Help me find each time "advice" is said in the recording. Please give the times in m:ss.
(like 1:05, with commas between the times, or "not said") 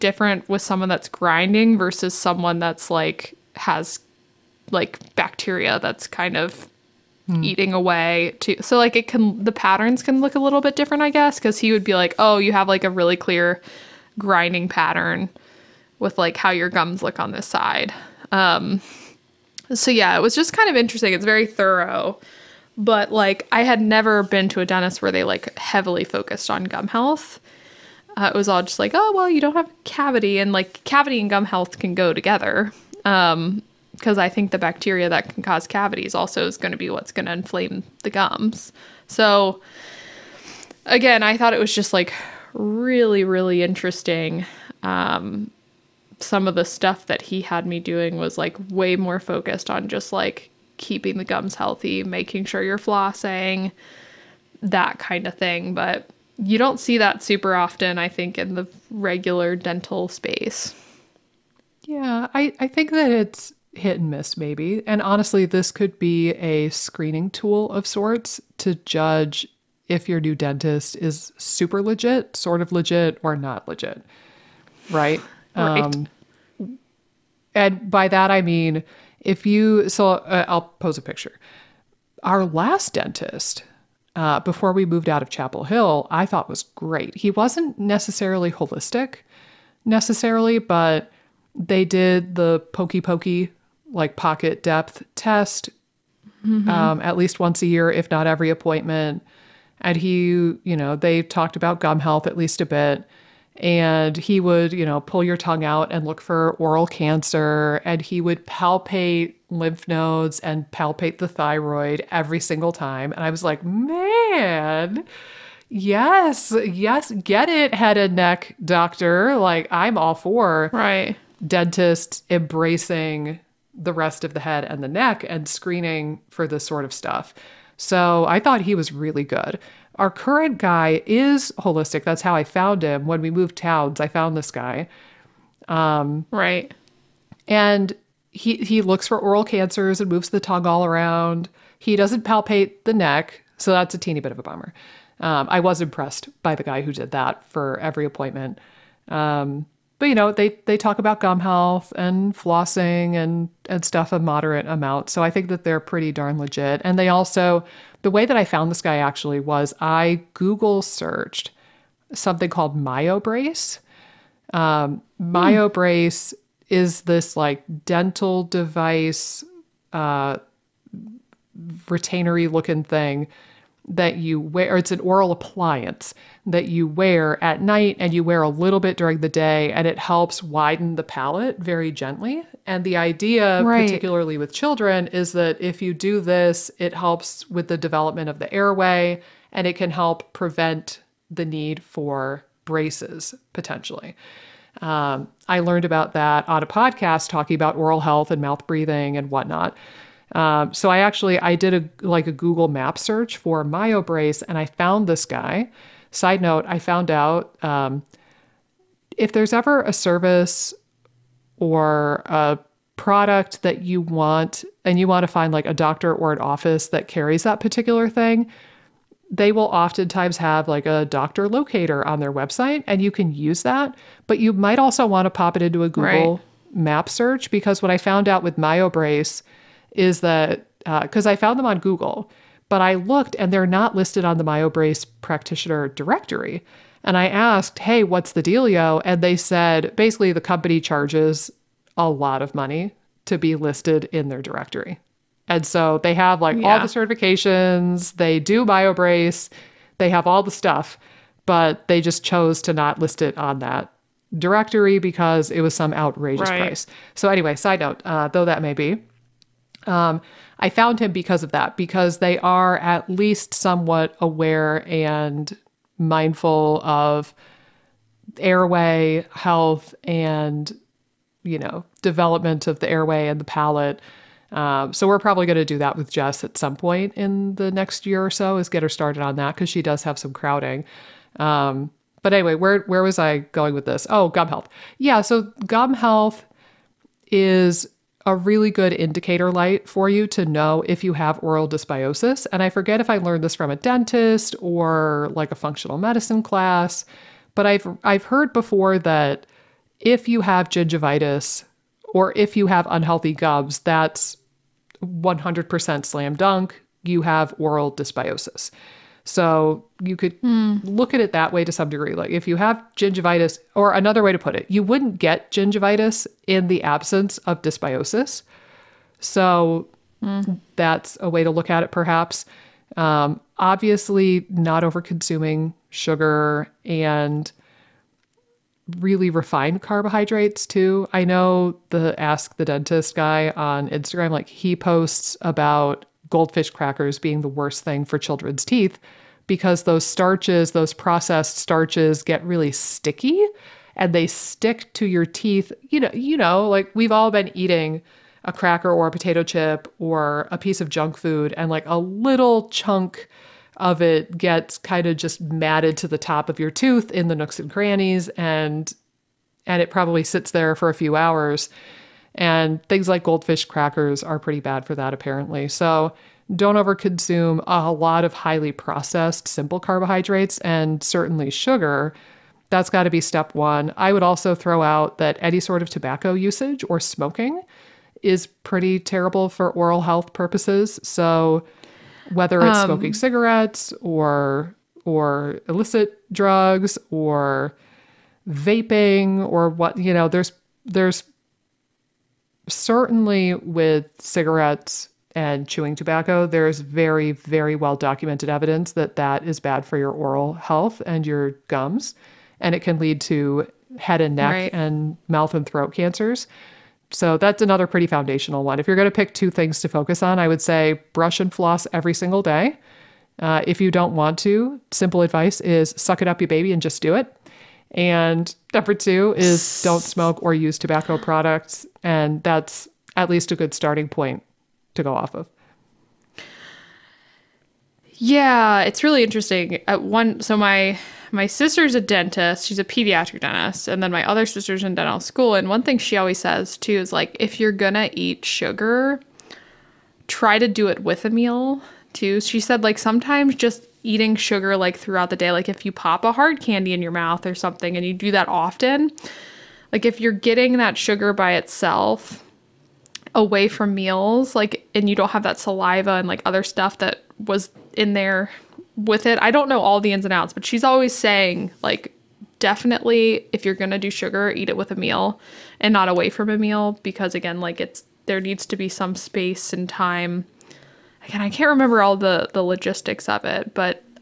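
6:55.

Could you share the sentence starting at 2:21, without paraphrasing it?
He doesn't palpate the neck, so that's a teeny bit of a bummer.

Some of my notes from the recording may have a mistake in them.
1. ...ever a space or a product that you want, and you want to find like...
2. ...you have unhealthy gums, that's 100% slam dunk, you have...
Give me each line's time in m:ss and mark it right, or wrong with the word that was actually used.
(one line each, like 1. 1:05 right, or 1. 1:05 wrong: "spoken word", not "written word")
1. 3:29 wrong: "service", not "space"
2. 5:02 right.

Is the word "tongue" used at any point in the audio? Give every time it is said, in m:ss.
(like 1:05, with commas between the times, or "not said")
1:45, 2:20.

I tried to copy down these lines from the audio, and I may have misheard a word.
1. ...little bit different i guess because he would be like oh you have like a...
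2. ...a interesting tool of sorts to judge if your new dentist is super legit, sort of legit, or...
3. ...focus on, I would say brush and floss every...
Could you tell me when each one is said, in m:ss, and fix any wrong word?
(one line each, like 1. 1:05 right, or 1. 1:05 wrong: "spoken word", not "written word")
1. 0:10 right
2. 1:06 wrong: "screening", not "interesting"
3. 6:49 right.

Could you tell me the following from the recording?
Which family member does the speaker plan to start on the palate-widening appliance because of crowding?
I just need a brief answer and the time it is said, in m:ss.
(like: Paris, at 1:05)
Jess, at 4:36.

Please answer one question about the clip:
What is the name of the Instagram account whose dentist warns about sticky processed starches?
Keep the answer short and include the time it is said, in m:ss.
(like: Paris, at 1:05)
Ask the Dentist, at 5:32.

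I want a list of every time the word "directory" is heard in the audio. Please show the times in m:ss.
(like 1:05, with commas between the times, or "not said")
3:55, 4:04, 4:14.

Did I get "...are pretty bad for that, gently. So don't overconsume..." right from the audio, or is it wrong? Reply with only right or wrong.
wrong.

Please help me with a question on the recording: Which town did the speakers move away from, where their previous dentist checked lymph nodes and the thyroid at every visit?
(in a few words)
Chapel Hill.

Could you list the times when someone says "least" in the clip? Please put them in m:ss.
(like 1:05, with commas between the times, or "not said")
1:37, 1:42, 4:23, 7:03.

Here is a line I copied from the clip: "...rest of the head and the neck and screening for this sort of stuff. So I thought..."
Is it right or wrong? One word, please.
right.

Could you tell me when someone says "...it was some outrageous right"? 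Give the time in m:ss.
4:15.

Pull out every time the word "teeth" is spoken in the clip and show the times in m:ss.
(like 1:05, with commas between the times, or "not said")
5:38, 5:45.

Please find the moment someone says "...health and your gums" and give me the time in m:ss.
6:40.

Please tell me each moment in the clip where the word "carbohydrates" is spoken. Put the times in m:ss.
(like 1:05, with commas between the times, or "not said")
5:29, 6:09.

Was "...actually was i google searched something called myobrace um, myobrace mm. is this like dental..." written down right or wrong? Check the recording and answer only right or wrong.
right.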